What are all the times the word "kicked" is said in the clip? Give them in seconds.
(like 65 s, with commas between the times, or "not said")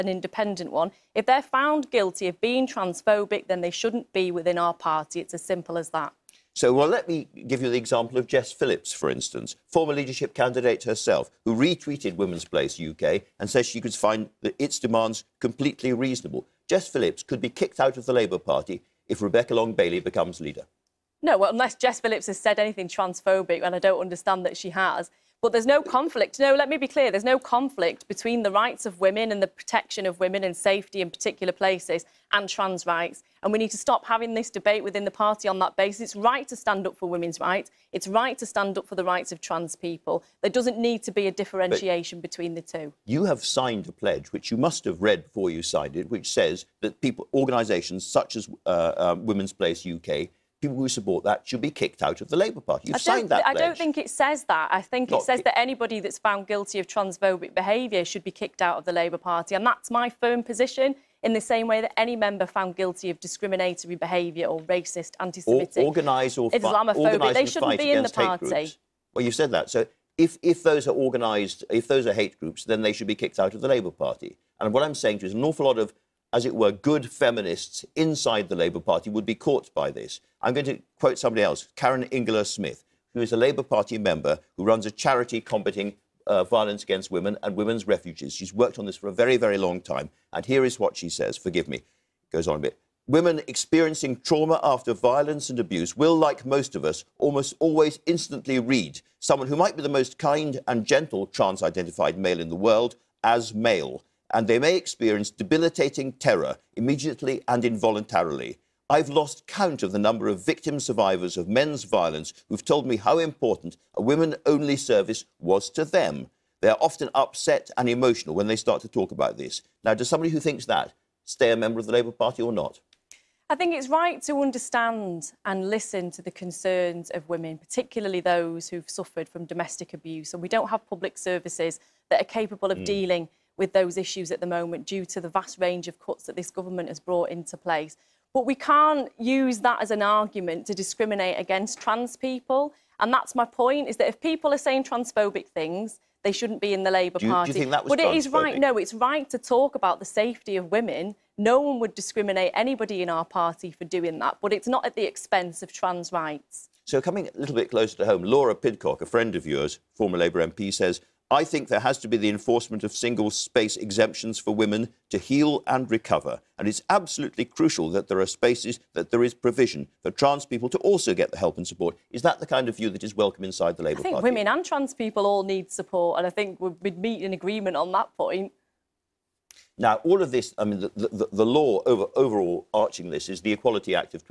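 17 s, 51 s, 58 s, 73 s.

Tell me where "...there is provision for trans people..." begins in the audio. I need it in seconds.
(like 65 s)
169 s.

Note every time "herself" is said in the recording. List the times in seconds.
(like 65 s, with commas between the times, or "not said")
10 s.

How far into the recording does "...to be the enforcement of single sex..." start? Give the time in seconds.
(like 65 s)
161 s.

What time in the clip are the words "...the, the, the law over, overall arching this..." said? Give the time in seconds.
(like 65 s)
180 s.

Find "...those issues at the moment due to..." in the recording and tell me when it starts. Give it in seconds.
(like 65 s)
133 s.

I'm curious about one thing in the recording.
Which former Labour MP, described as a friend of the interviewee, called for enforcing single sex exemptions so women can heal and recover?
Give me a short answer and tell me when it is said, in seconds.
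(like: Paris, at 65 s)
Laura Pidcock, at 158 s.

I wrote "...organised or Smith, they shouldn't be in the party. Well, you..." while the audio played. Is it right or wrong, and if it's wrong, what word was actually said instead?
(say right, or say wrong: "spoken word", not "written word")
wrong: "Islamophobic", not "Smith".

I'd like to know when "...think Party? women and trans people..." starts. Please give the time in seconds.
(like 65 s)
174 s.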